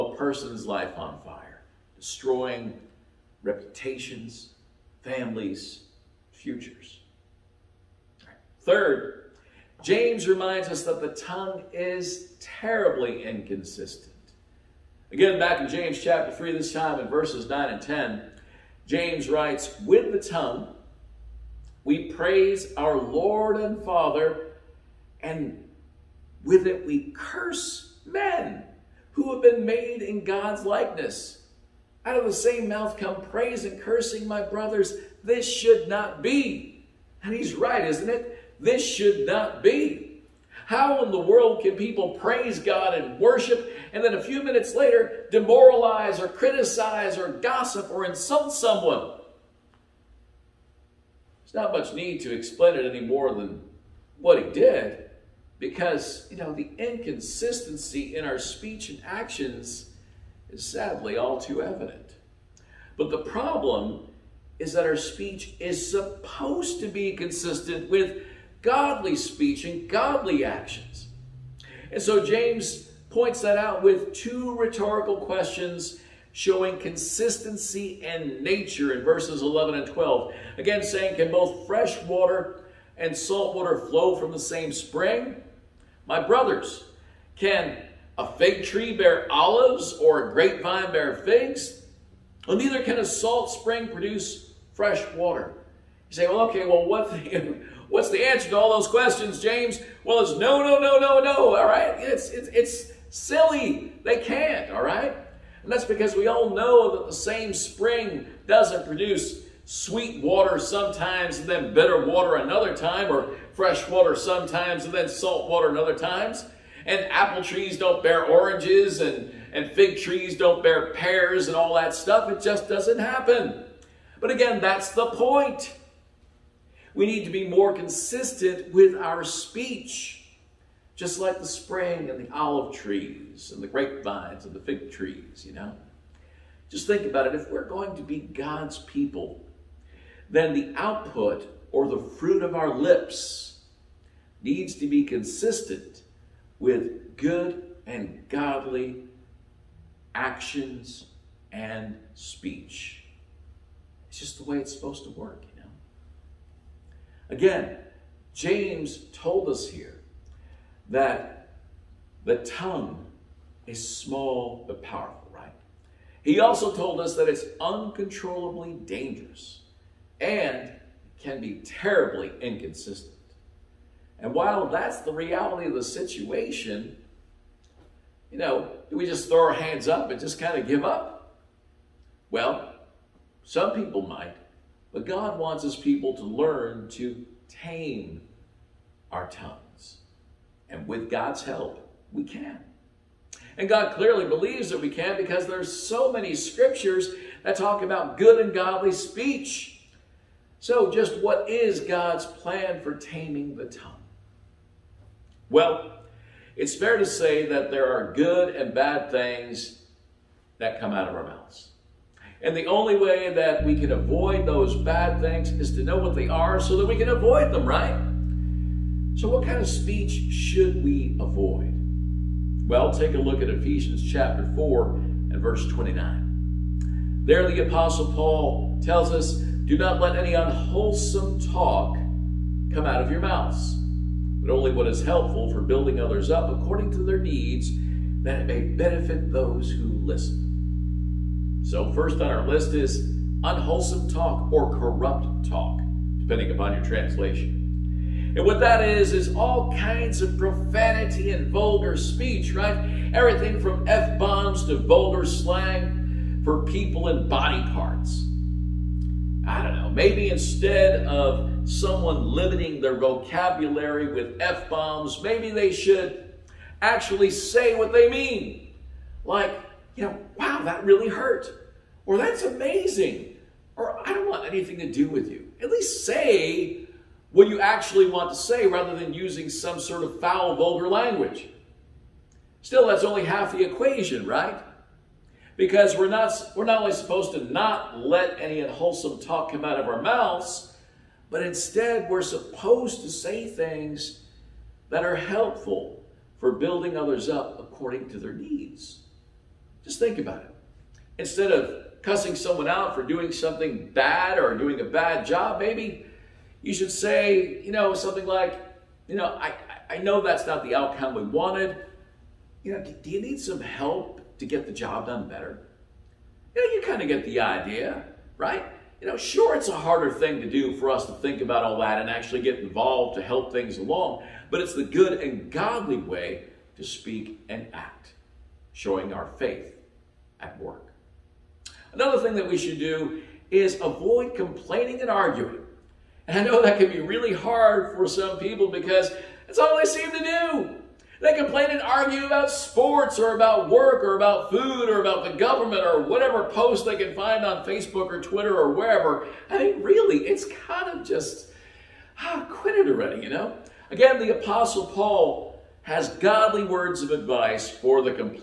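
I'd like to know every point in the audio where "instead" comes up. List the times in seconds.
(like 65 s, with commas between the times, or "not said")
260 s, 291 s, 301 s.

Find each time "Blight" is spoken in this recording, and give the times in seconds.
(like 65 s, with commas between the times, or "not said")
not said.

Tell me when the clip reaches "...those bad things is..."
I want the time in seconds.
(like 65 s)
214 s.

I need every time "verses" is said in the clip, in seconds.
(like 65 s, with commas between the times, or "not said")
17 s, 79 s, 225 s.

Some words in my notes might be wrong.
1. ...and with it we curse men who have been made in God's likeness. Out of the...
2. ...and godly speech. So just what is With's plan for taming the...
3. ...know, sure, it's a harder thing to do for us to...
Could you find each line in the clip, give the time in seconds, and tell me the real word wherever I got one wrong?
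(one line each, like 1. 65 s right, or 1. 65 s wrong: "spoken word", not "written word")
1. 25 s right
2. 198 s wrong: "God", not "With"
3. 319 s right.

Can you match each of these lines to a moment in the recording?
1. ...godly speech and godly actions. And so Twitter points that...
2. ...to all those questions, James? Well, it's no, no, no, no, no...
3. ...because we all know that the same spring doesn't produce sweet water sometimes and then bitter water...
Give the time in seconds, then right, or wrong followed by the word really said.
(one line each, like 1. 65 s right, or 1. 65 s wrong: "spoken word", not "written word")
1. 68 s wrong: "James", not "Twitter"
2. 98 s right
3. 105 s right.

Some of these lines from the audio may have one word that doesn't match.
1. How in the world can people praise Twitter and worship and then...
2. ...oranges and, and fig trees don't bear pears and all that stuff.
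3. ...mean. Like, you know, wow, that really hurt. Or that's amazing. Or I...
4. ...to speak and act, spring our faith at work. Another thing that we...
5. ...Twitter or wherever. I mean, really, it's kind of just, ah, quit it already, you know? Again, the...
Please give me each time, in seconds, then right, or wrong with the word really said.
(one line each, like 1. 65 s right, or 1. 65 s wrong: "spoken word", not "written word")
1. 40 s wrong: "God", not "Twitter"
2. 118 s right
3. 268 s right
4. 326 s wrong: "showing", not "spring"
5. 348 s right.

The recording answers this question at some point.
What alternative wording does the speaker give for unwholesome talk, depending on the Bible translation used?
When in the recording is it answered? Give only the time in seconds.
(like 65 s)
244 s.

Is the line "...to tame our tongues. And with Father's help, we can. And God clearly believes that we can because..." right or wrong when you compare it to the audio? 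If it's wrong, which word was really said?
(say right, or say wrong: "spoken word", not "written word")
wrong: "God", not "Father".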